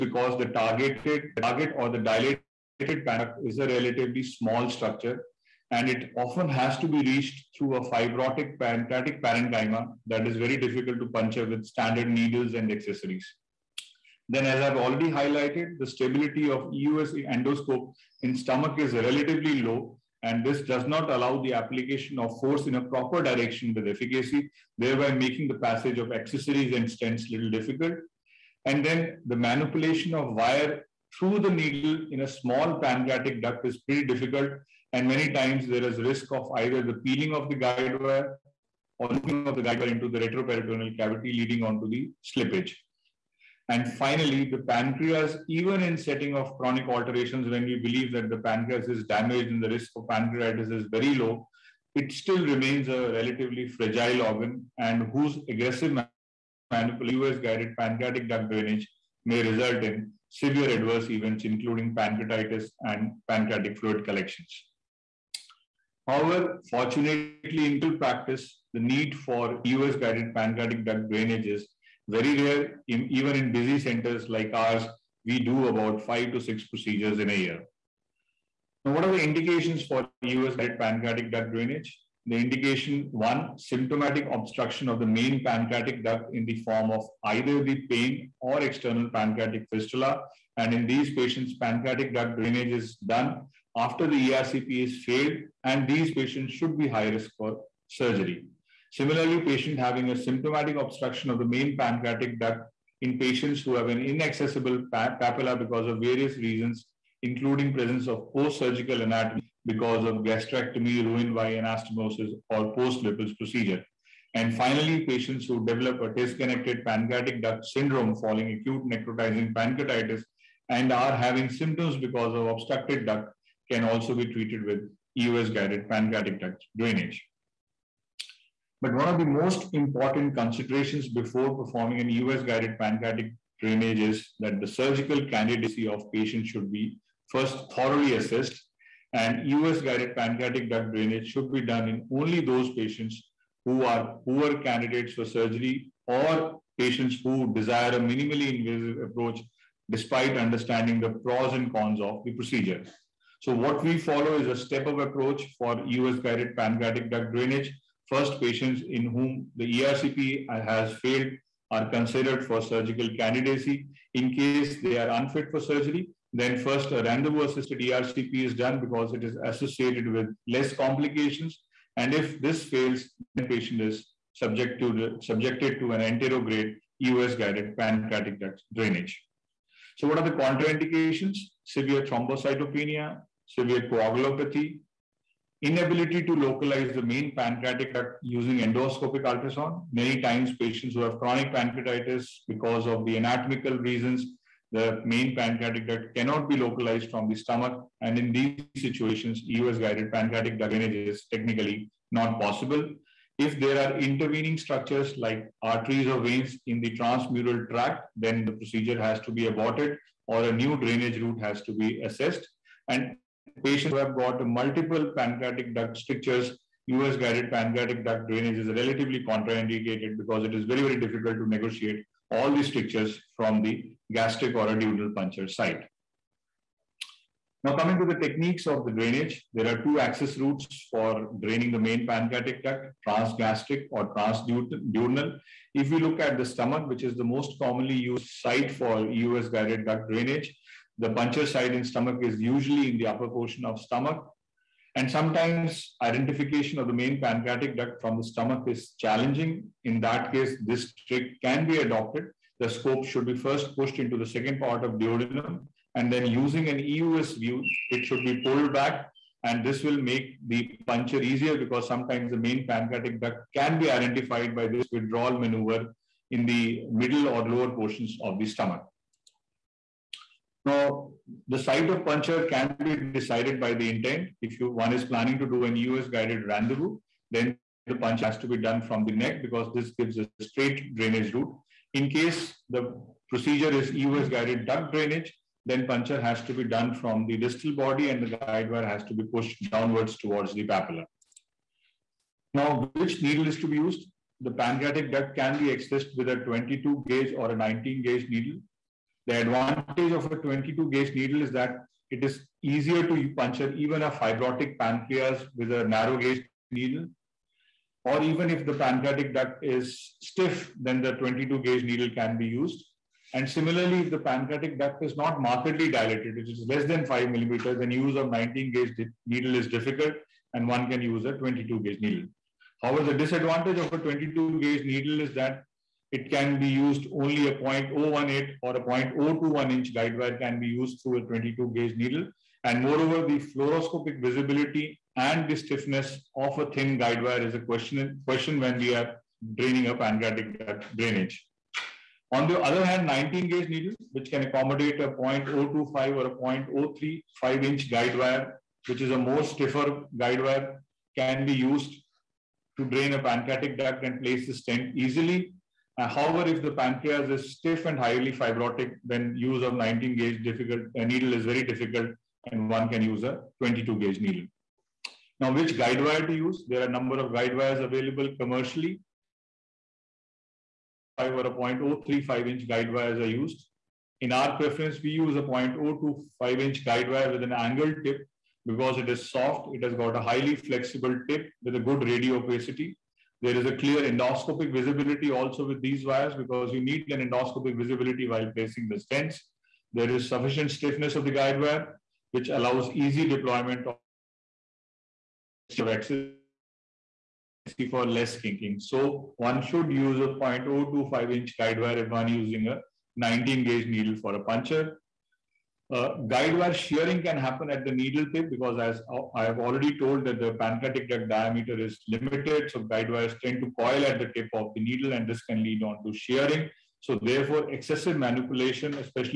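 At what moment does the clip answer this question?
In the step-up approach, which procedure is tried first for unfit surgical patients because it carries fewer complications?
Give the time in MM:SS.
02:47.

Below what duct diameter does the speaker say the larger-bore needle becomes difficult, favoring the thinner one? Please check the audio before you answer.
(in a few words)
5 millimeters.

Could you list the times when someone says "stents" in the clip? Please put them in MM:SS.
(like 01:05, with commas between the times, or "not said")
00:26, 05:54, 06:28.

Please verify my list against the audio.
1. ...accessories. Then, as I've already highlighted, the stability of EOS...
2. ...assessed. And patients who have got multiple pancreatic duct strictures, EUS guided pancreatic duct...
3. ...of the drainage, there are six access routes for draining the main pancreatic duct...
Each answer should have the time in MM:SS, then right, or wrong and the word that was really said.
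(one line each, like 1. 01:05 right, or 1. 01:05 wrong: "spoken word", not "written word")
1. 00:12 wrong: "EUS", not "EOS"
2. 03:32 right
3. 03:48 wrong: "two", not "six".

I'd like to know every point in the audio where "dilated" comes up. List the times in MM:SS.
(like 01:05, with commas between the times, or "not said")
00:01, 05:15.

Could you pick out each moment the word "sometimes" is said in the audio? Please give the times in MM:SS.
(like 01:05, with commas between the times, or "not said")
04:05, 04:21.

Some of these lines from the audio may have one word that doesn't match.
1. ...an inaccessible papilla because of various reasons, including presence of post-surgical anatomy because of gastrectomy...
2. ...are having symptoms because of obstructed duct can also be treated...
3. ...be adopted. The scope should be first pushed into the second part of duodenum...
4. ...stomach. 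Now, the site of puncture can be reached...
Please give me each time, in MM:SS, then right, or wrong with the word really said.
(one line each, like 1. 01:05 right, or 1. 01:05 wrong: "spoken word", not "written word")
1. 01:43 right
2. 02:00 right
3. 04:11 right
4. 04:28 wrong: "decided", not "reached".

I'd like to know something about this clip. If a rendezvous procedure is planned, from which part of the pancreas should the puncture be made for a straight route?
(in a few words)
the neck.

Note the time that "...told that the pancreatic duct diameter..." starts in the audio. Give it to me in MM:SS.
06:49.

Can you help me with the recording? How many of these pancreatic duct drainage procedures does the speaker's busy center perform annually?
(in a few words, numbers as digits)
5 to 6.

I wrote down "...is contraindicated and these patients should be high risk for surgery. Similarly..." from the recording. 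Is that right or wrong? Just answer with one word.
wrong.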